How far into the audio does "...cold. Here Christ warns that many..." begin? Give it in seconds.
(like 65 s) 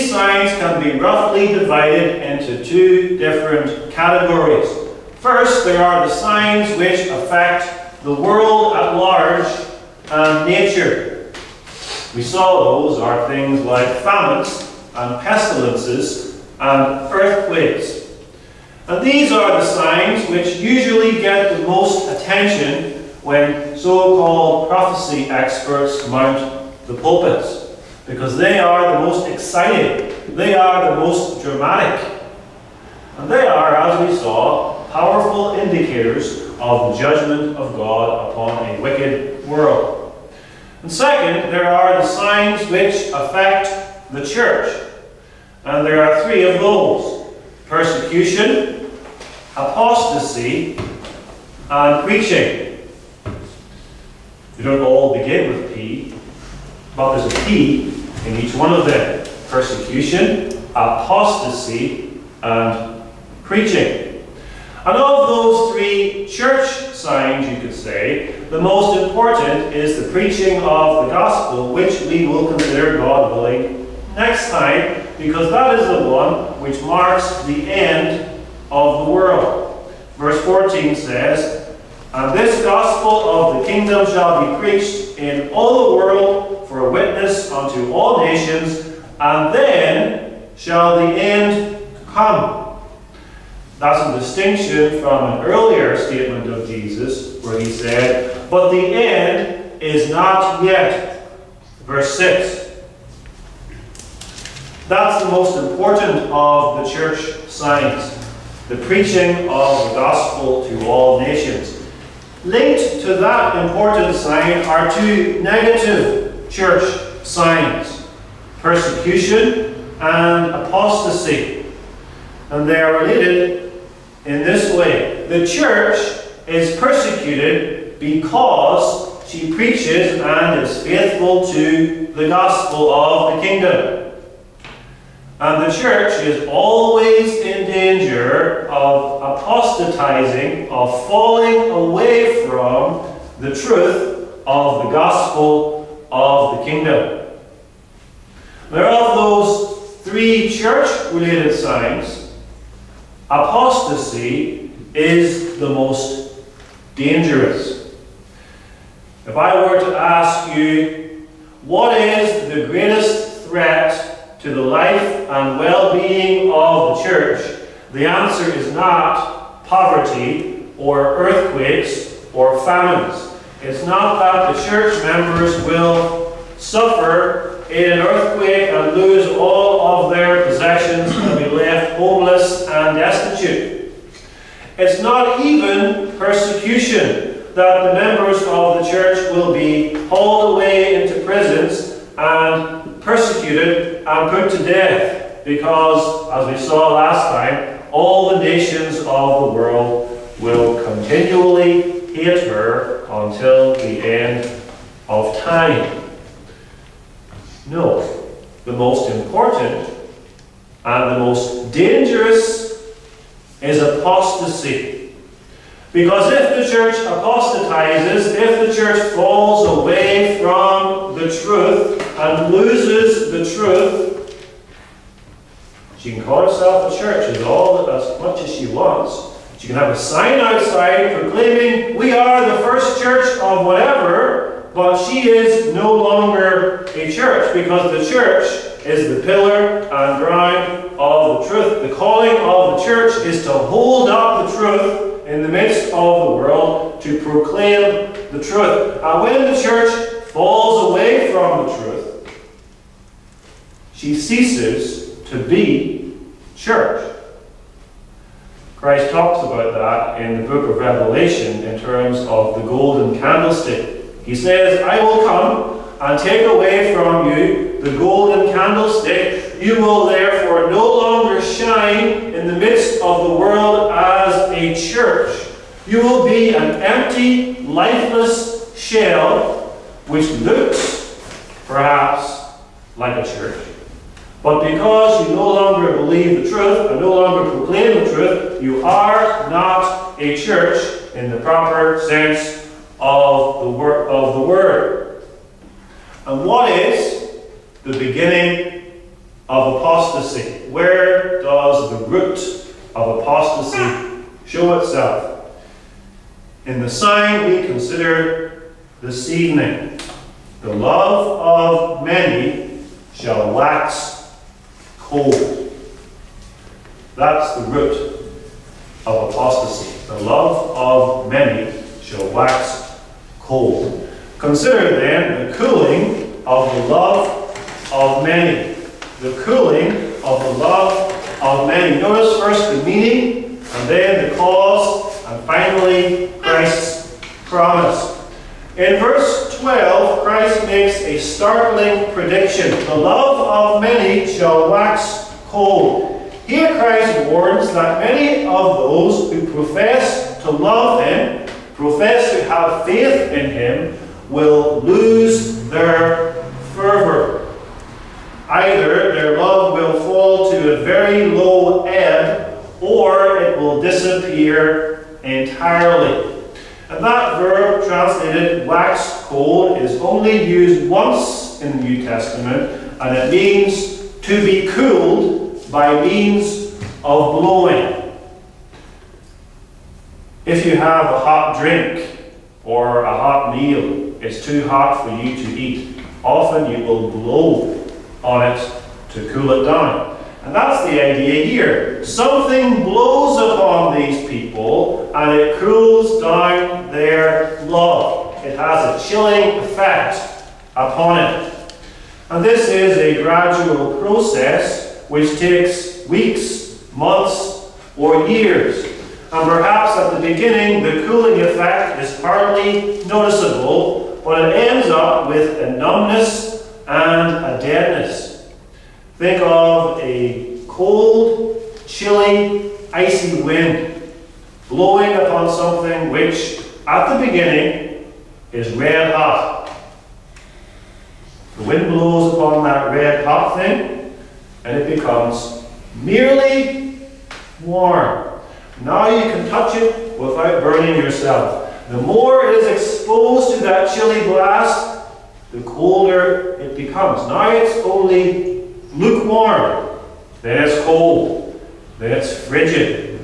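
345 s.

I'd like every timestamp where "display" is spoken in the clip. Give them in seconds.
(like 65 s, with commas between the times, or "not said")
not said.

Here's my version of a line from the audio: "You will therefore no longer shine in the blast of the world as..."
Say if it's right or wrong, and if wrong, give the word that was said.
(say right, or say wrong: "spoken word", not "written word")
wrong: "midst", not "blast".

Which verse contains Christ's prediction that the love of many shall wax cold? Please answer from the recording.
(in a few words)
Verse 12.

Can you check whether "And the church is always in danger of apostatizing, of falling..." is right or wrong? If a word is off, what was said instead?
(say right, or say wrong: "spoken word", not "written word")
right.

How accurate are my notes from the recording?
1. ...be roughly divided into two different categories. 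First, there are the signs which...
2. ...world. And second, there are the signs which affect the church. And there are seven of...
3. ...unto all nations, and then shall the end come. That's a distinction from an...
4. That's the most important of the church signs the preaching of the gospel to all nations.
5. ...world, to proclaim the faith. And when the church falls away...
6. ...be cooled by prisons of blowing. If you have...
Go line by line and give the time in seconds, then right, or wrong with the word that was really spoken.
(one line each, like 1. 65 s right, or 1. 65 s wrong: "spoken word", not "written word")
1. 0 s right
2. 39 s wrong: "three", not "seven"
3. 87 s right
4. 104 s right
5. 246 s wrong: "truth", not "faith"
6. 374 s wrong: "means", not "prisons".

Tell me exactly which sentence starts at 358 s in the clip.
Either their love will fall to a very low ebb or it will disappear entirely.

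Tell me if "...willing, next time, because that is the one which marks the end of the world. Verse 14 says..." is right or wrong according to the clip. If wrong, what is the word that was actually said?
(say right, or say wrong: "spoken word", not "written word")
right.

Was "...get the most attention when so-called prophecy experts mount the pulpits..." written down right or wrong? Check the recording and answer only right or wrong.
right.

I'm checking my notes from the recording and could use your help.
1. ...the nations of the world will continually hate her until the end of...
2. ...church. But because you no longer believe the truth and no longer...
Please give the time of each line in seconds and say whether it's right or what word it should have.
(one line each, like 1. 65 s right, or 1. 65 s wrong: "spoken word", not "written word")
1. 198 s right
2. 283 s right.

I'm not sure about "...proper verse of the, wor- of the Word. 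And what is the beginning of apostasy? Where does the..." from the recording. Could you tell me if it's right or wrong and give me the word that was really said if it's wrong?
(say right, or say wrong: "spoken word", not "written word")
wrong: "sense", not "verse".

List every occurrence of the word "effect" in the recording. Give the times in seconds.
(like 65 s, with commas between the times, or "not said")
399 s, 411 s.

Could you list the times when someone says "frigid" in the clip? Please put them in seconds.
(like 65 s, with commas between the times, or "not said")
452 s.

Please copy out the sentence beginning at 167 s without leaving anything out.
The answer is not poverty or earthquakes or famines.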